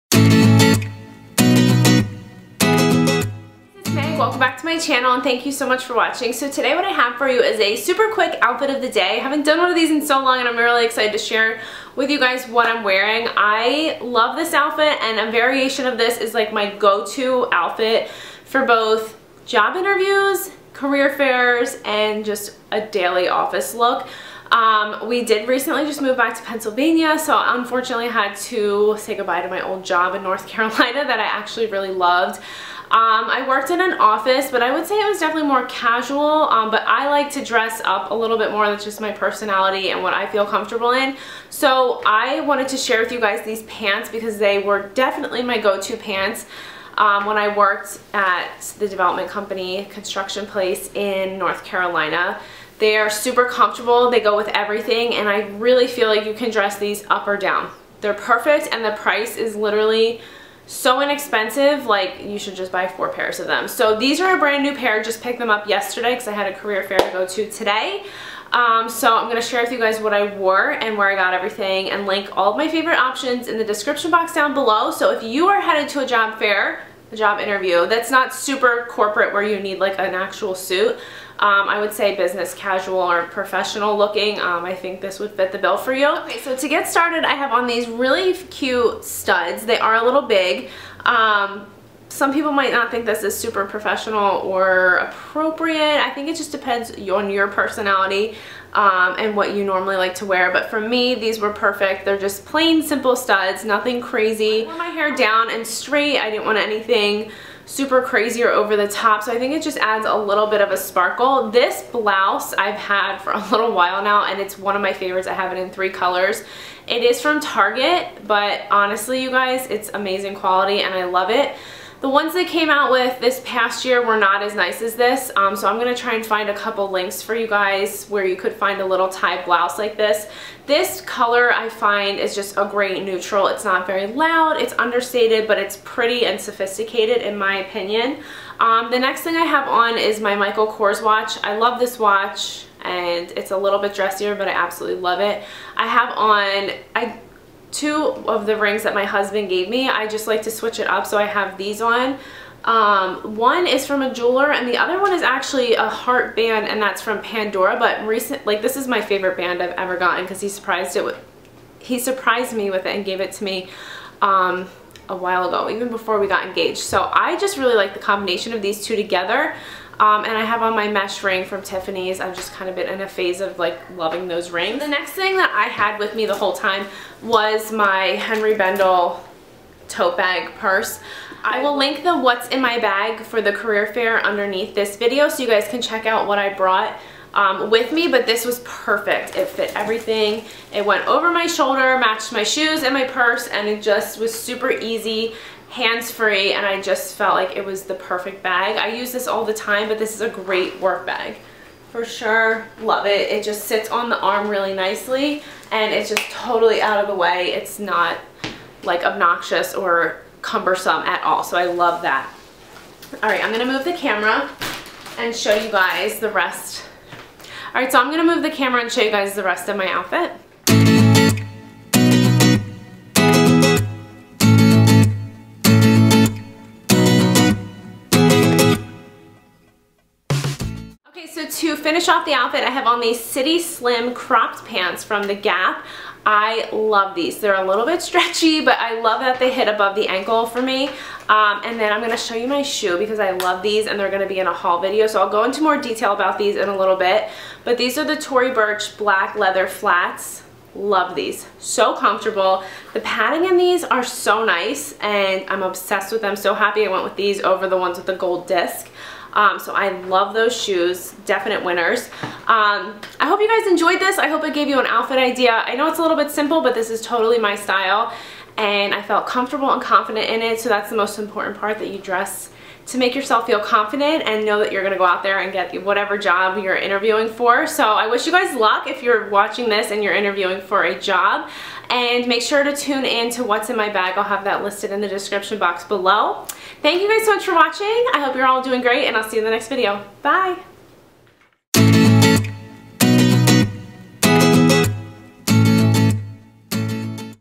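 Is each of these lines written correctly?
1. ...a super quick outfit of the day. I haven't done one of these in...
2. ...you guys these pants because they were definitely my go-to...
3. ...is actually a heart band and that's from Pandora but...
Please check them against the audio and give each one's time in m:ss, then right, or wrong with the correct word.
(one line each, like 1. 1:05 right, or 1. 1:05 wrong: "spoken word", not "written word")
1. 0:07 right
2. 0:43 right
3. 2:35 right.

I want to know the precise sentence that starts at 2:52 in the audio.
I've just kind of been in a phase of like loving those rings.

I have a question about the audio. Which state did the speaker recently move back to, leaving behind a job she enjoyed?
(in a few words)
Pennsylvania.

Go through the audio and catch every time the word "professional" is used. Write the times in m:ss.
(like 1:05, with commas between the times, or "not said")
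1:23, 1:33.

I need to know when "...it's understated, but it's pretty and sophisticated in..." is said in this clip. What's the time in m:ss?
2:14.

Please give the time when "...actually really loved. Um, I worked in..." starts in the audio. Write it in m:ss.
0:31.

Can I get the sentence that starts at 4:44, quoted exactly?
I'll have that listed in the description box below.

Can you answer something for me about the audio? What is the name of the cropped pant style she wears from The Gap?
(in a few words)
City Slim.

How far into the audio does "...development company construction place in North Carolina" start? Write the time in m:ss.
0:48.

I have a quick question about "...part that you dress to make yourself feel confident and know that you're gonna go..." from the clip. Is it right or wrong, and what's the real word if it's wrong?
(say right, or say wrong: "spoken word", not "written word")
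right.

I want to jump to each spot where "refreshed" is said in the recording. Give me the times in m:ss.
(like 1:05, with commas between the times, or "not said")
not said.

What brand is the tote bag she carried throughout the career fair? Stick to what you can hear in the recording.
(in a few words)
Henri Bendel.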